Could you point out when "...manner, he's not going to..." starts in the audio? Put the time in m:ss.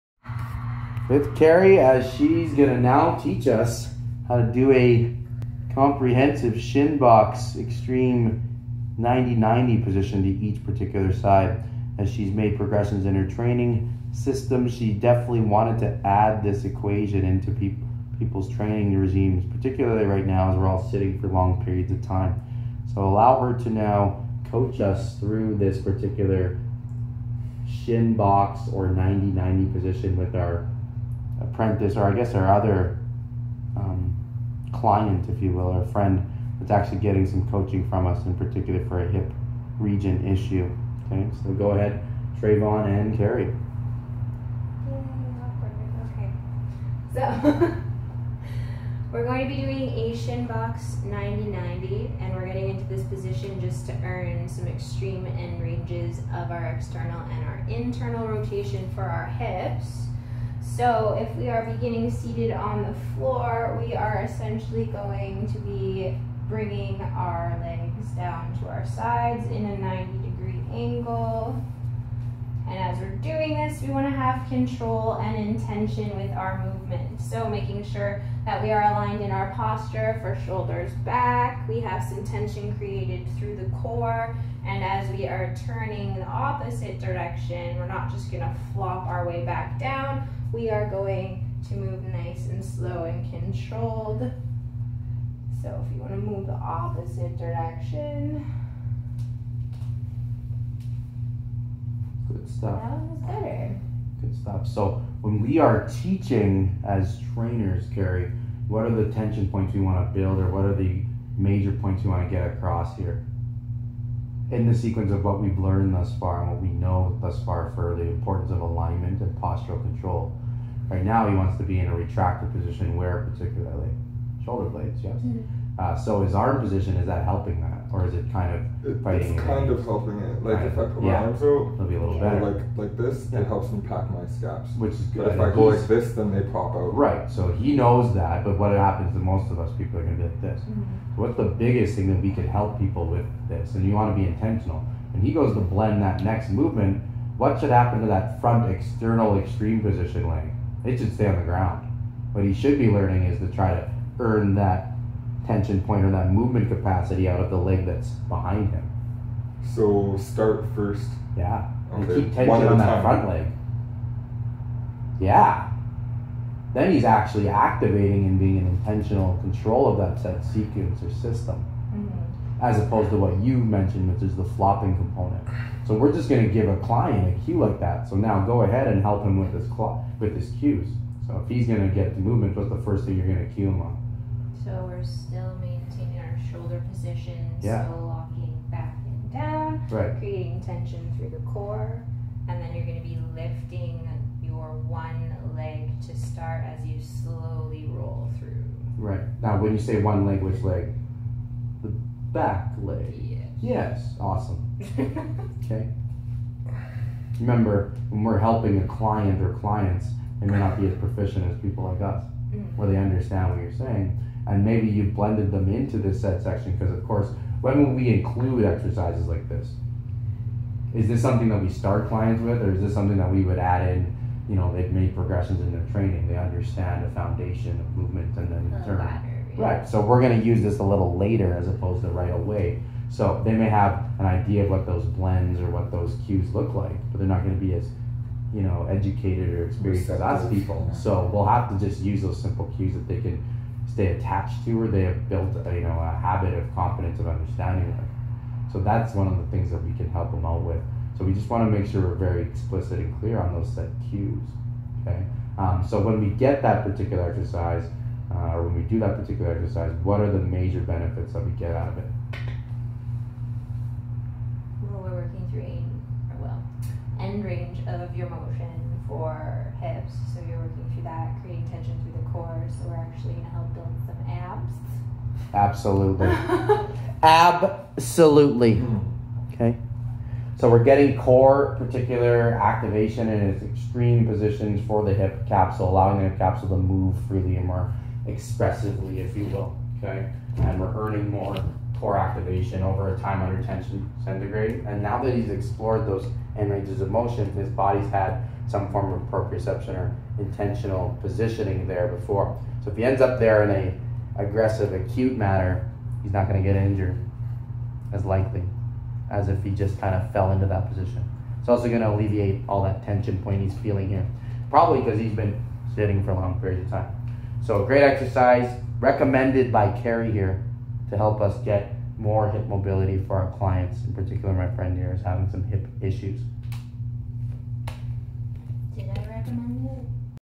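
5:05.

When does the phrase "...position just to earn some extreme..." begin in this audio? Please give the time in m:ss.
0:53.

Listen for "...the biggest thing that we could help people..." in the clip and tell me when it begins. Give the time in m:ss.
2:21.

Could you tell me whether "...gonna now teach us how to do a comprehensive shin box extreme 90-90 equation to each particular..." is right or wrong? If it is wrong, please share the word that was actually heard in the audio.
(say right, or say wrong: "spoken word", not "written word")
wrong: "position", not "equation".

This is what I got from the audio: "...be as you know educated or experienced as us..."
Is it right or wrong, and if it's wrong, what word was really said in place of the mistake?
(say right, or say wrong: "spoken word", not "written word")
right.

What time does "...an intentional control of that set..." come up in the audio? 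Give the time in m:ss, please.
2:48.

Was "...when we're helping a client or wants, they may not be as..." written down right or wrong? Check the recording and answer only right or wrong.
wrong.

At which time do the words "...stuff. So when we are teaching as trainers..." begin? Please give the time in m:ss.
1:44.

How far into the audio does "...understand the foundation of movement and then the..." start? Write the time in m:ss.
3:46.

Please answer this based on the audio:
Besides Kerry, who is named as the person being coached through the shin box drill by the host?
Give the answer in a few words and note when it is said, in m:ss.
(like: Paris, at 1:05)
Trayvon, at 0:42.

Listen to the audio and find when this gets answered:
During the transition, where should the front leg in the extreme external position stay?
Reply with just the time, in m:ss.
2:31.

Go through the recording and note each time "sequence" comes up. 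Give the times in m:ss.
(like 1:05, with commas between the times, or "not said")
1:54, 2:50.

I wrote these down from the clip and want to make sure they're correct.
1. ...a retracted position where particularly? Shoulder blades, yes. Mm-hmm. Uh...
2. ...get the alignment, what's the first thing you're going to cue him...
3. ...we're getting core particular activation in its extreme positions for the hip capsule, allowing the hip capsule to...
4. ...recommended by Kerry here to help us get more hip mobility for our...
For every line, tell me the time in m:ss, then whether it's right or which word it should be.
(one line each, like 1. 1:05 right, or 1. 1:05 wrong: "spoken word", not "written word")
1. 2:01 right
2. 3:01 wrong: "movement", not "alignment"
3. 4:40 right
4. 5:18 right.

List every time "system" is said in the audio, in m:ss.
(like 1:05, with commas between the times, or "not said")
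0:14, 2:51.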